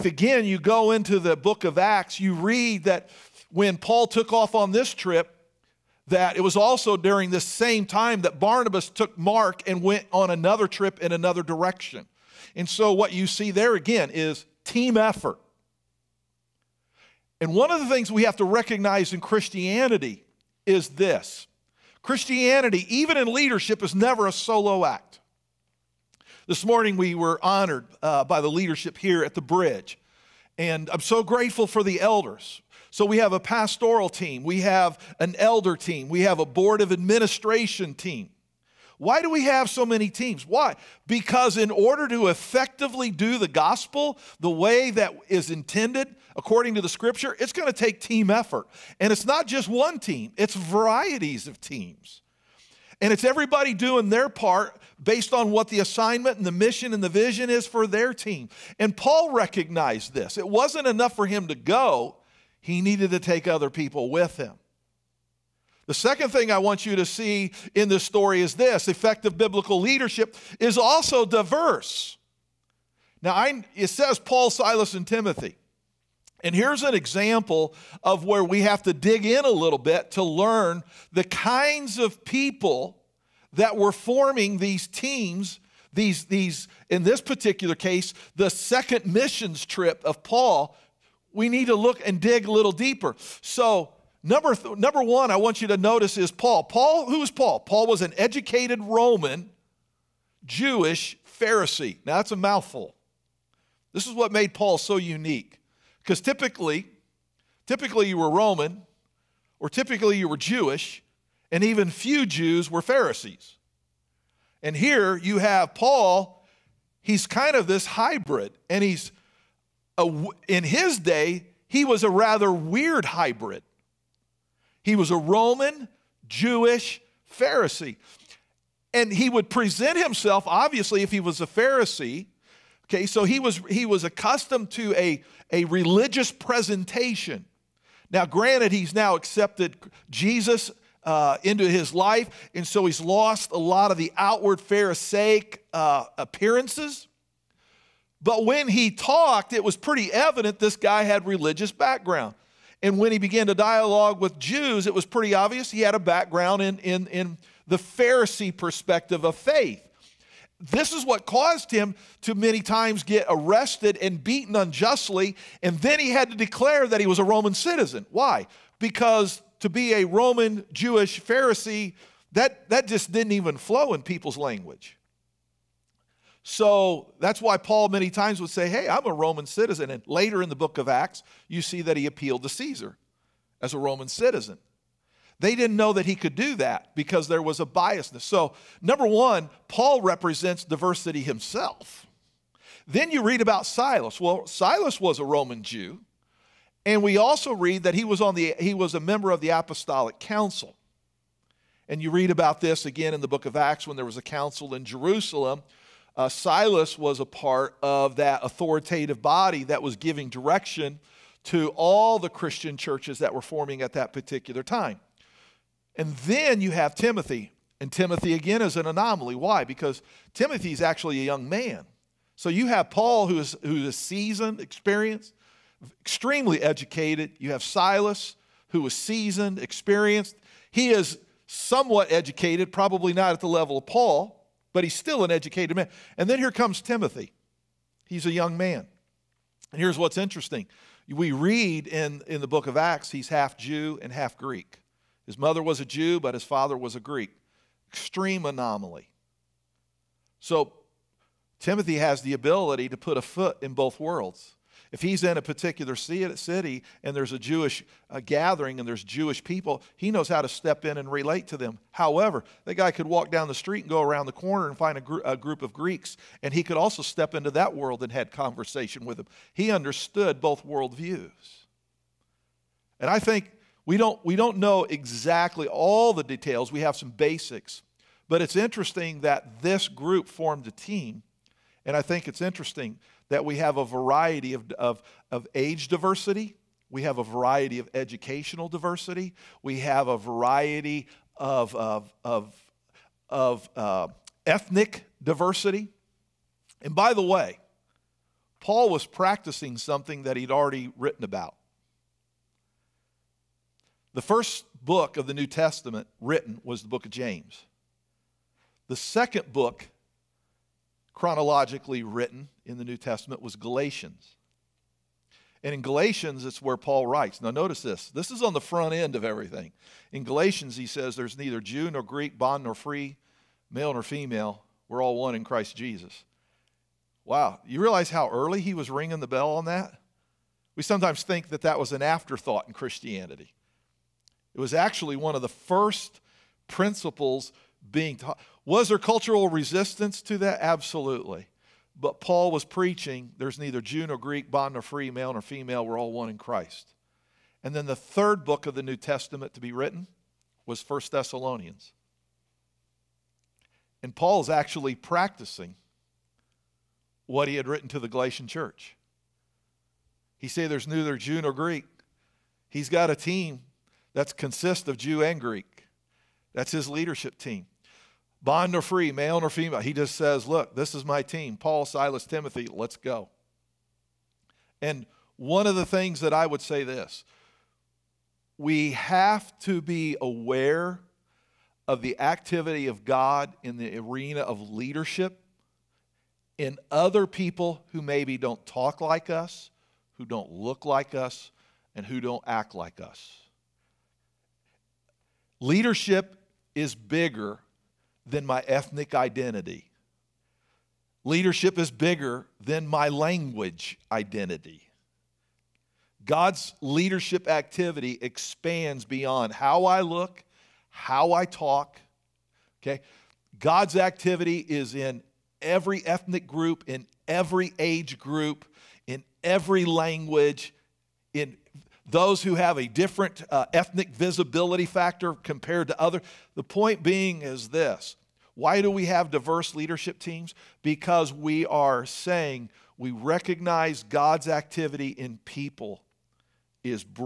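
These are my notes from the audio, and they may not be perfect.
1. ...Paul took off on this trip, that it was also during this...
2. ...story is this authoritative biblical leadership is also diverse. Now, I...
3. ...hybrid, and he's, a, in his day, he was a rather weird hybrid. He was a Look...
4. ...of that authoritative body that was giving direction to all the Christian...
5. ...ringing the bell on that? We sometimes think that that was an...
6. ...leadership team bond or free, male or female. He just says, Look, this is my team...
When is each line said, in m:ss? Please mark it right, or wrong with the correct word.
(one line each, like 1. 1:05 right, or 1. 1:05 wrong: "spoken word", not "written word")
1. 0:03 right
2. 1:08 wrong: "effective", not "authoritative"
3. 1:57 wrong: "Roman", not "Look"
4. 3:27 right
5. 5:28 right
6. 6:06 right.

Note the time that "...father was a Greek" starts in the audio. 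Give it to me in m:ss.
4:06.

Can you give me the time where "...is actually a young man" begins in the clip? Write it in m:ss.
3:40.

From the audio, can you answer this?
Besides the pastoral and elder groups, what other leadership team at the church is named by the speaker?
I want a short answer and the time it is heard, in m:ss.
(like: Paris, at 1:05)
board of administration, at 0:36.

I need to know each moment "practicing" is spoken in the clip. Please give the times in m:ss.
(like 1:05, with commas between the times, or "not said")
4:59, 5:54.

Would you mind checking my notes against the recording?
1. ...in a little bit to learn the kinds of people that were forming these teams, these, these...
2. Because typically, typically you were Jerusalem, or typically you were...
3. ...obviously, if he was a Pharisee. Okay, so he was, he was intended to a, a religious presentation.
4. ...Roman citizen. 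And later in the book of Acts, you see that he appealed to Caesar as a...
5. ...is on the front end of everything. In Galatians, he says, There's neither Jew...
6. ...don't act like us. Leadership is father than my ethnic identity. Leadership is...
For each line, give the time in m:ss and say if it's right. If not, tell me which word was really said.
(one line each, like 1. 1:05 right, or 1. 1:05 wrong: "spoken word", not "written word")
1. 1:19 right
2. 1:46 wrong: "Roman", not "Jerusalem"
3. 2:10 wrong: "accustomed", not "intended"
4. 2:59 right
5. 5:18 right
6. 6:32 wrong: "bigger", not "father".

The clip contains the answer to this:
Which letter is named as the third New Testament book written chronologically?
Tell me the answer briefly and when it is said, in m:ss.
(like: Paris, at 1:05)
First Thessalonians, at 5:50.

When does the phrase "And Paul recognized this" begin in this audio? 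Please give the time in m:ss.
0:58.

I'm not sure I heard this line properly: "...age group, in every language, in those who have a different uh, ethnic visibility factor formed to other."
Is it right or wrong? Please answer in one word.
wrong.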